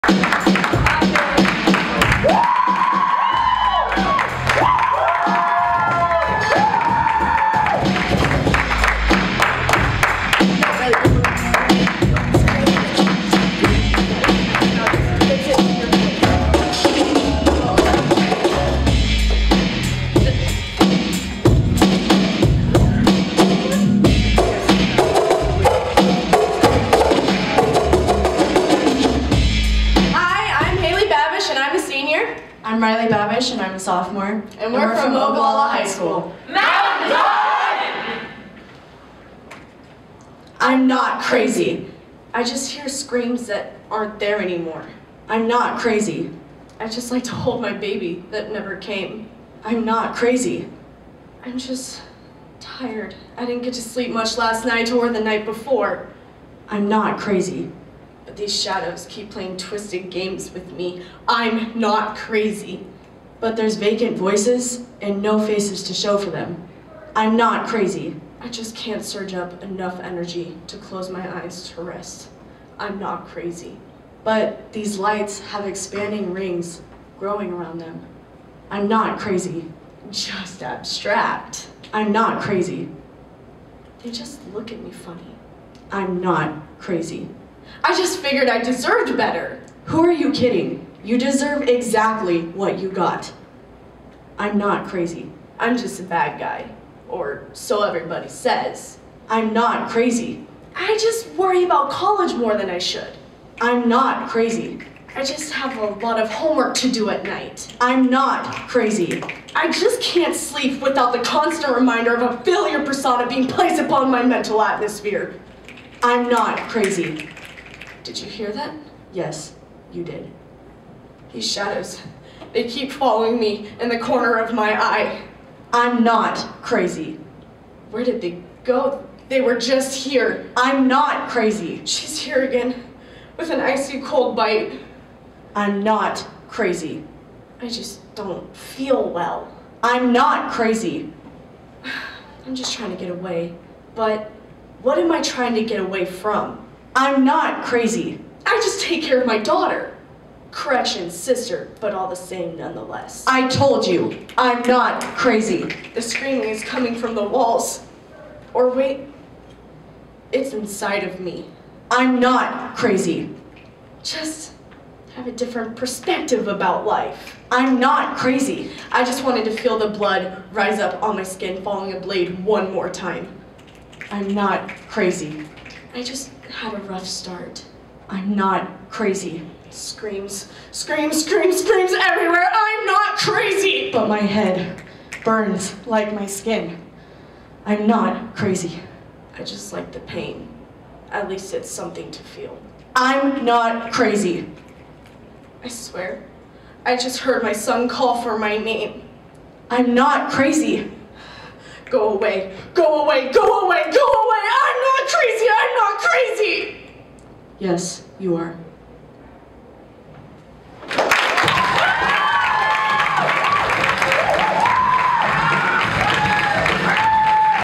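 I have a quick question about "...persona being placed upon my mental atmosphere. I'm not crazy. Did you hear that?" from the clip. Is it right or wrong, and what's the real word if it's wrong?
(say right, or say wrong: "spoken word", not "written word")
right.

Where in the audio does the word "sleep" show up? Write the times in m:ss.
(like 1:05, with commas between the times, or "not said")
0:53, 1:50.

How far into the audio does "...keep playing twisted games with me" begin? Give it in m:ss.
0:59.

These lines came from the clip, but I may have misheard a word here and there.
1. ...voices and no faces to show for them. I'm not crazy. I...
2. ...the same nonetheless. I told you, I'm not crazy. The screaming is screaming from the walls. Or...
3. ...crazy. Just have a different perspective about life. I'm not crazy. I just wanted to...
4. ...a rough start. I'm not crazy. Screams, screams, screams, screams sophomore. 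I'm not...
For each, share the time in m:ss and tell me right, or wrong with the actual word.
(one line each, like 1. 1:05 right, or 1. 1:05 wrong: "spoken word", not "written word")
1. 1:04 right
2. 2:32 wrong: "coming", not "screaming"
3. 2:42 right
4. 2:56 wrong: "everywhere", not "sophomore".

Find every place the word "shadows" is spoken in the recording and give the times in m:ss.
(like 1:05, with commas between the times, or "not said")
0:58, 2:01.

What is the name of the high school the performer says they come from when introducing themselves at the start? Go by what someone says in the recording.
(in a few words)
Ogallala High School.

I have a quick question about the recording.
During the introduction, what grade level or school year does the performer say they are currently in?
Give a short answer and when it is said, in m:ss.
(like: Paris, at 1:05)
Sophomore, at 0:33.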